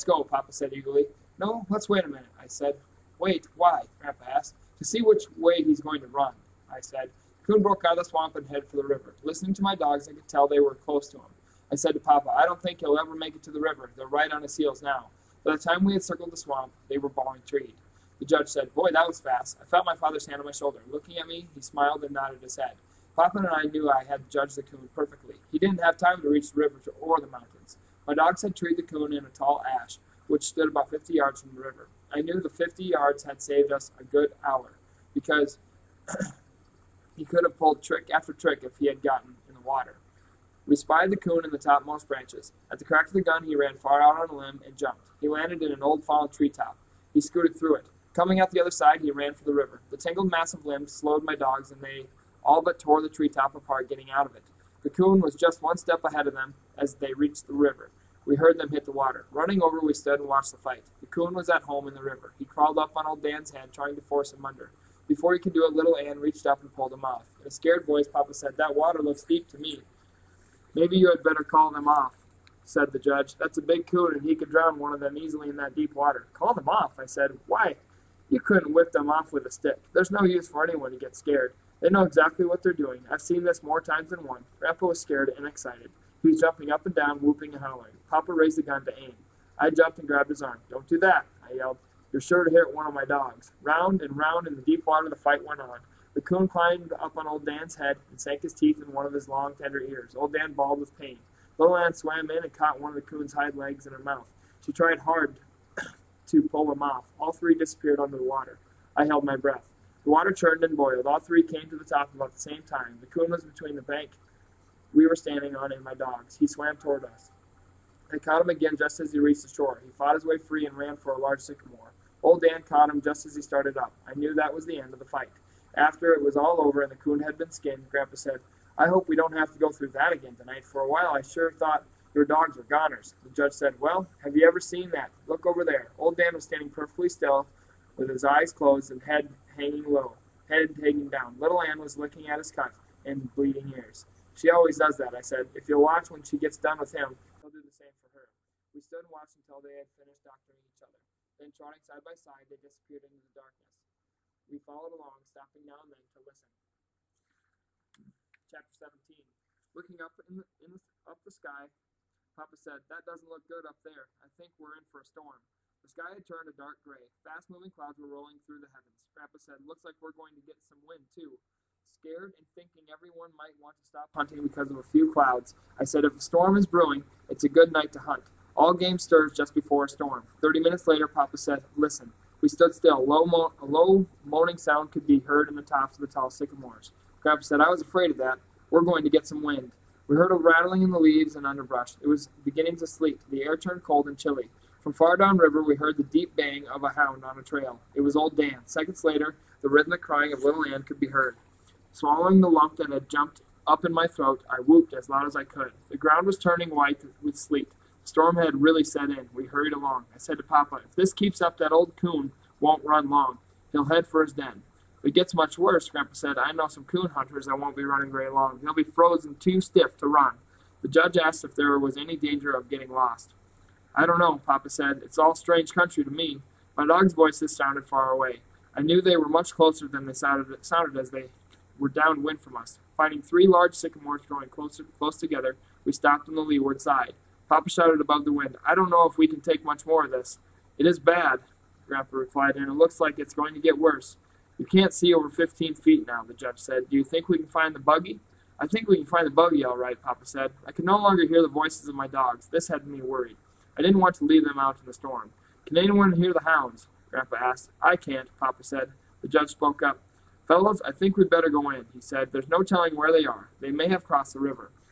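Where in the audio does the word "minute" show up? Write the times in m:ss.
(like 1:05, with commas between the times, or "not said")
0:02, 3:00.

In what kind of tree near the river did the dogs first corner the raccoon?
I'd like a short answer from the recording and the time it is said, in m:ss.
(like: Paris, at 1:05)
ash, at 0:29.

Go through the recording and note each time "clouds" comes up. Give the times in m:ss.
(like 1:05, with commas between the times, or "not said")
2:47, 2:55.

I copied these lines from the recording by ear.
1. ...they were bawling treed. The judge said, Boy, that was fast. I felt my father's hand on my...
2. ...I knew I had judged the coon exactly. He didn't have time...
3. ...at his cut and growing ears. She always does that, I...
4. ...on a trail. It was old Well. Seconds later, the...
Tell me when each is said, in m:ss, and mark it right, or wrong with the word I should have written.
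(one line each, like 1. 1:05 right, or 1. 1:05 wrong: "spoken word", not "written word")
1. 0:16 right
2. 0:23 wrong: "perfectly", not "exactly"
3. 2:22 wrong: "bleeding", not "growing"
4. 3:17 wrong: "Dan", not "Well".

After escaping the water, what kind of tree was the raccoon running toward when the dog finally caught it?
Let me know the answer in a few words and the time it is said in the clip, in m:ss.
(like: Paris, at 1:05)
sycamore, at 2:01.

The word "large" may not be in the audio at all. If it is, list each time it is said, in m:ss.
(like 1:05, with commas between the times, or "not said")
2:01, 3:53.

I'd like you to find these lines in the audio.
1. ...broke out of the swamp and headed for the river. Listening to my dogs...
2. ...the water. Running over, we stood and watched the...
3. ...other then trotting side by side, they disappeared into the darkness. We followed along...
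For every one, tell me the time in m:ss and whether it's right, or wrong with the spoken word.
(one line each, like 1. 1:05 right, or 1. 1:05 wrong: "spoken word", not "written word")
1. 0:07 right
2. 0:58 right
3. 2:30 right.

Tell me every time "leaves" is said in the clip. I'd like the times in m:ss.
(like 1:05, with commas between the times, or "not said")
3:10, 4:14.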